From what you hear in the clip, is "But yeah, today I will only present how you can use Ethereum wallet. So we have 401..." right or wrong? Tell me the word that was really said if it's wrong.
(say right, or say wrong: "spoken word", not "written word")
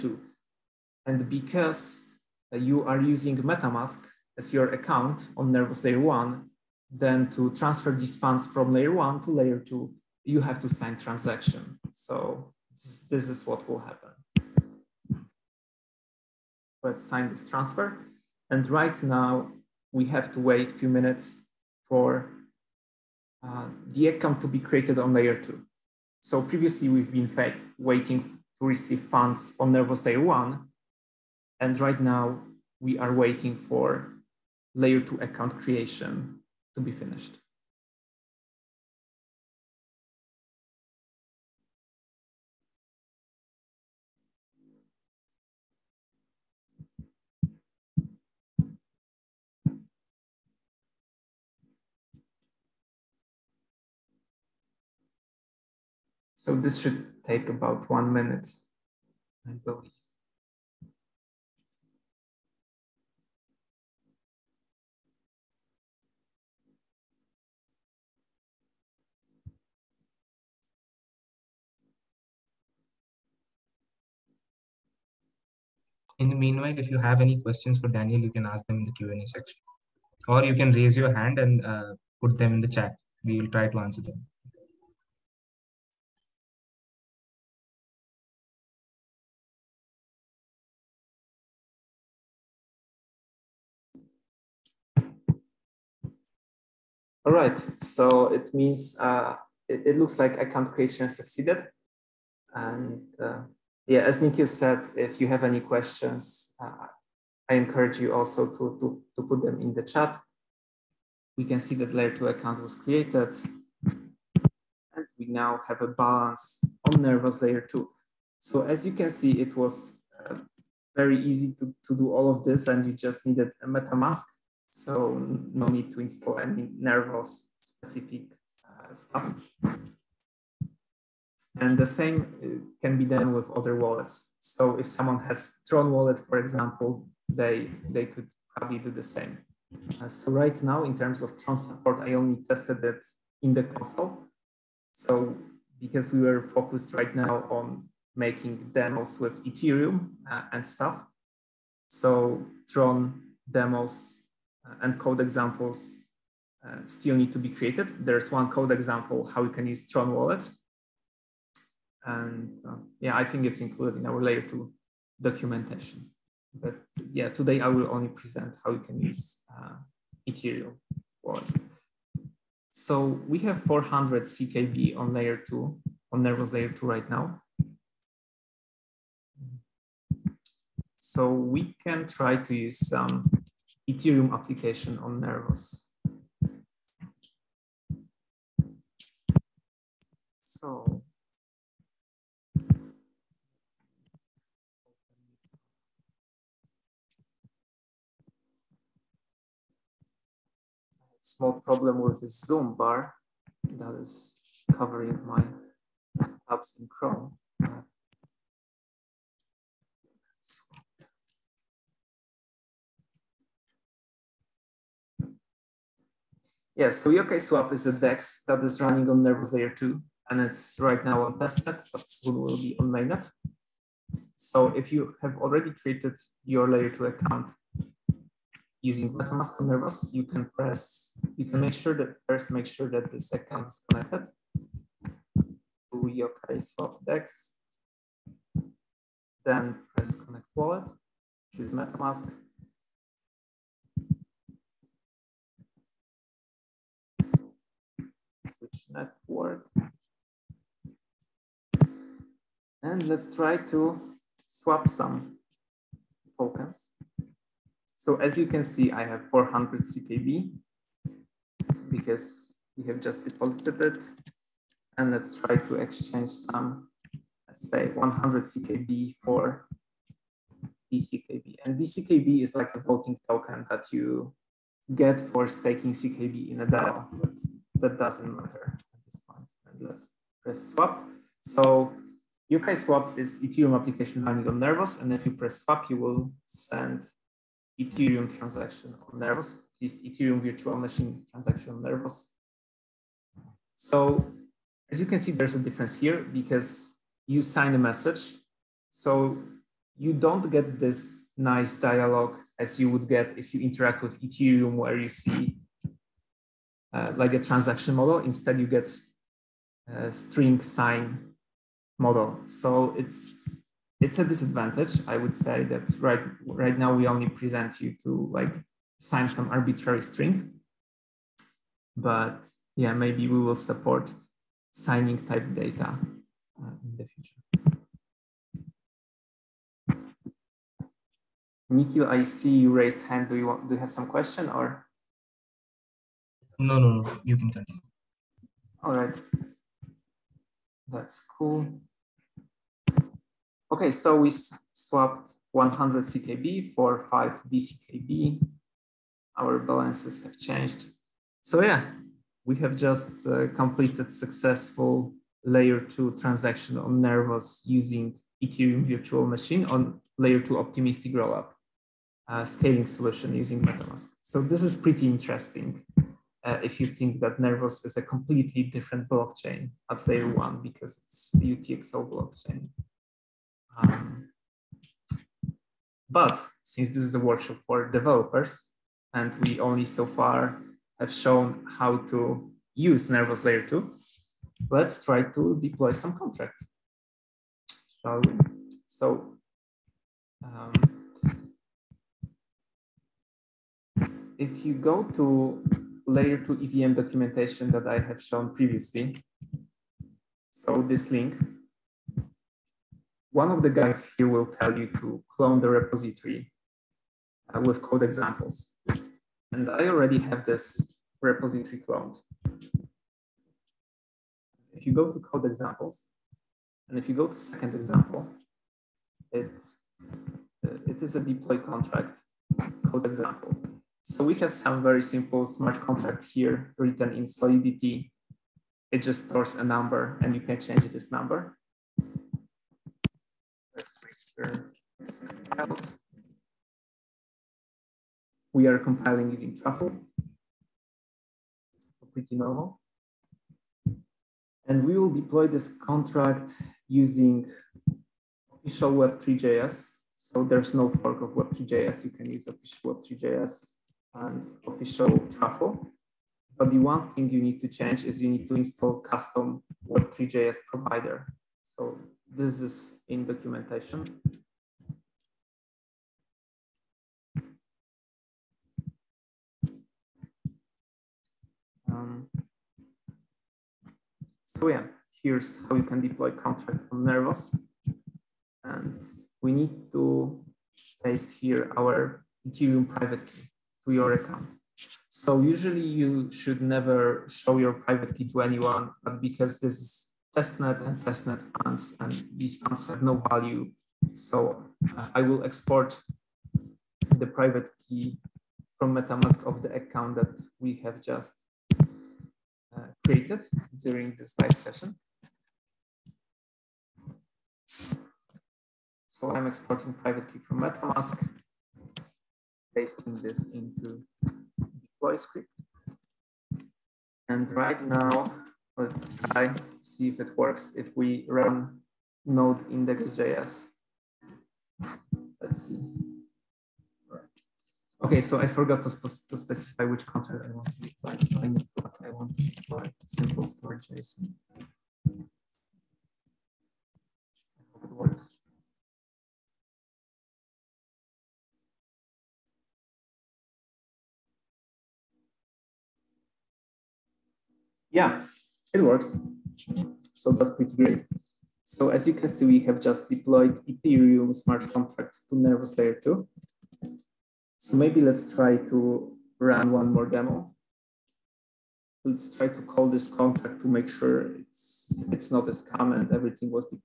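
wrong: "400", not "401".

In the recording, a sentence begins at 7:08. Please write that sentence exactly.
It just stores a number and you can change this number.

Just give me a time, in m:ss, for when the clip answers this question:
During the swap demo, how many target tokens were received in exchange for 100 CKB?
5:47.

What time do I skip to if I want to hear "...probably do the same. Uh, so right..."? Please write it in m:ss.
2:18.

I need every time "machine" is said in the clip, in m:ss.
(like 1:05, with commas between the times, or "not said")
4:50, 5:59.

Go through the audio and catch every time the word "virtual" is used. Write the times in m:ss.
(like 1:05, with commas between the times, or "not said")
4:50, 5:58.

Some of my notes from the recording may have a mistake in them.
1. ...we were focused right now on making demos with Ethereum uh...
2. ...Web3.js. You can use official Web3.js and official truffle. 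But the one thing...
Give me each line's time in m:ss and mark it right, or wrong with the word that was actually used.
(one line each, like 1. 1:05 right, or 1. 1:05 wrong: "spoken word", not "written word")
1. 2:26 right
2. 7:31 right.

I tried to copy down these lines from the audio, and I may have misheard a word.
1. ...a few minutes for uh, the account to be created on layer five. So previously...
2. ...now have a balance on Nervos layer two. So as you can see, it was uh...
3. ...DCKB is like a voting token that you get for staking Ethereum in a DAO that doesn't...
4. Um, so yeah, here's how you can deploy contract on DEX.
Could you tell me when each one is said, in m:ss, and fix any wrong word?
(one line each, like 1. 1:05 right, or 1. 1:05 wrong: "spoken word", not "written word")
1. 0:20 wrong: "two", not "five"
2. 1:55 right
3. 4:31 wrong: "CKB", not "Ethereum"
4. 7:51 wrong: "Nervos", not "DEX".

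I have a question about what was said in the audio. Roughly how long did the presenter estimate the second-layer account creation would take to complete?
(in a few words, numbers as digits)
1 minute.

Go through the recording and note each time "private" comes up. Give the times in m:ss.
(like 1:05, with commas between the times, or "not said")
8:02, 8:07, 8:17, 8:29.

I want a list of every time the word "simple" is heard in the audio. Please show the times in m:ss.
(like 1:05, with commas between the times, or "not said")
7:05, 8:53.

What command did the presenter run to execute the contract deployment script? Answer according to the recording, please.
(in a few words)
node index.js.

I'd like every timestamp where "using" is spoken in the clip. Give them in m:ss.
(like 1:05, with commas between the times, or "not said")
0:03, 3:48, 5:57, 6:03, 7:19, 7:26.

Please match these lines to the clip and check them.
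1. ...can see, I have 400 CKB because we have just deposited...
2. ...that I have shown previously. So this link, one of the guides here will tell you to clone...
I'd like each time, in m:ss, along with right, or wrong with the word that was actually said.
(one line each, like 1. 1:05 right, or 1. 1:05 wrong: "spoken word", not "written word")
1. 4:18 right
2. 6:37 right.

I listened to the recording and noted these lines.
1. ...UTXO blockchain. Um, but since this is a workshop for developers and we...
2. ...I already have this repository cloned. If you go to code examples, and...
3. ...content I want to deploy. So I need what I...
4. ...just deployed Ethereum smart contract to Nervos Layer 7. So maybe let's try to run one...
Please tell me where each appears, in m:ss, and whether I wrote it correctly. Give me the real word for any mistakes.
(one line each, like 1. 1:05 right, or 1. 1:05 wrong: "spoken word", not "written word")
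1. 6:11 right
2. 6:49 right
3. 8:50 right
4. 9:12 wrong: "2", not "7".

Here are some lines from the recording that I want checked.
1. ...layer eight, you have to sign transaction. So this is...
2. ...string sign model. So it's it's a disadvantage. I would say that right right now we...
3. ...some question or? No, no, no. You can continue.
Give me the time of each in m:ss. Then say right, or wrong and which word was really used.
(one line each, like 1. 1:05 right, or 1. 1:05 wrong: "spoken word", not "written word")
1. 0:09 wrong: "two", not "eight"
2. 5:10 right
3. 5:33 right.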